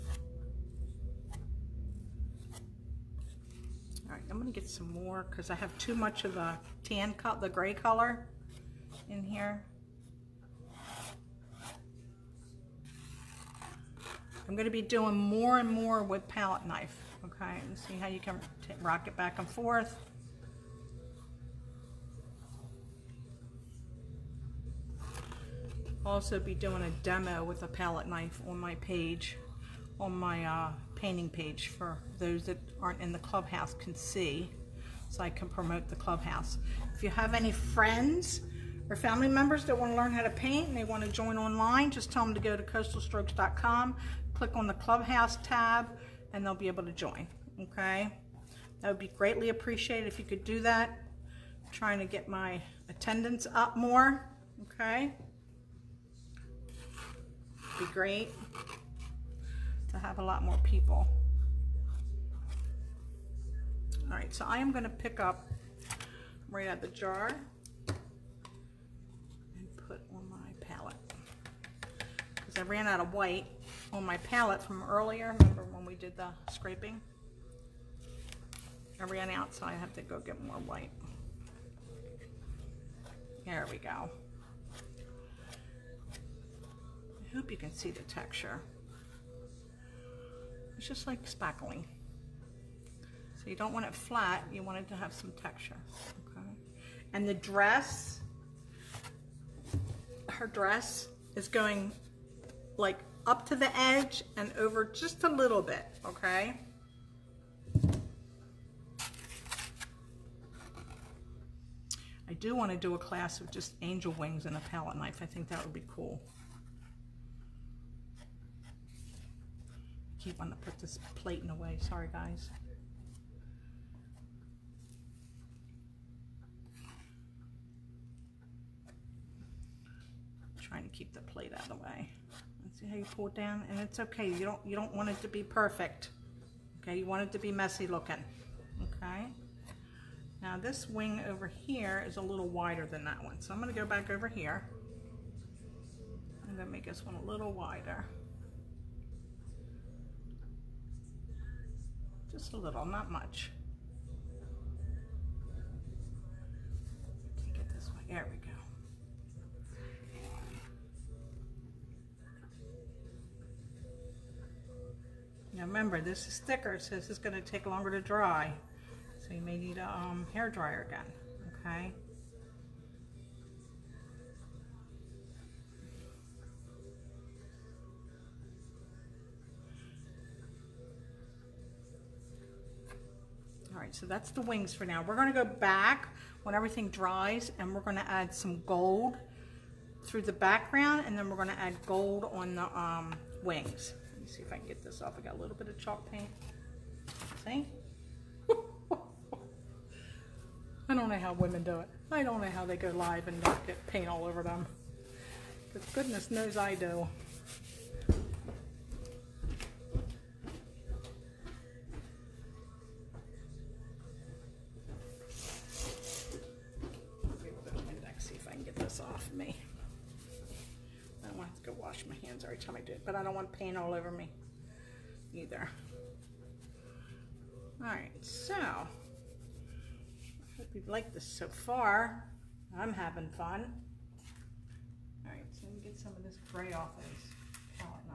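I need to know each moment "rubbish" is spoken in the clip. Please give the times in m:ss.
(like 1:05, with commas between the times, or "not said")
not said.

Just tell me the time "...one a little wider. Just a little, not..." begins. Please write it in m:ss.
2:27.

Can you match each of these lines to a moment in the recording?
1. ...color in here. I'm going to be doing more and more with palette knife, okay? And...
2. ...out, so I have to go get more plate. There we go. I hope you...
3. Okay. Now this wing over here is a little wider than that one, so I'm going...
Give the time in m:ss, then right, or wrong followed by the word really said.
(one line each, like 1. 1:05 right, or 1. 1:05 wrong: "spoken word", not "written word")
1. 0:07 right
2. 1:19 wrong: "white", not "plate"
3. 2:18 right.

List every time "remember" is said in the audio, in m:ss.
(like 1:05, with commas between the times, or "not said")
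1:15, 2:45.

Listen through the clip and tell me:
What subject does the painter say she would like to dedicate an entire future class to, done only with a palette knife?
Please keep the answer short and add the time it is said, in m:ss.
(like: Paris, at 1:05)
Angel wings, at 1:53.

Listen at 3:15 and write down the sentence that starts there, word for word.
I got a little bit of chalk paint.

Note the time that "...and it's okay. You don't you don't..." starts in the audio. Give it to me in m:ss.
2:13.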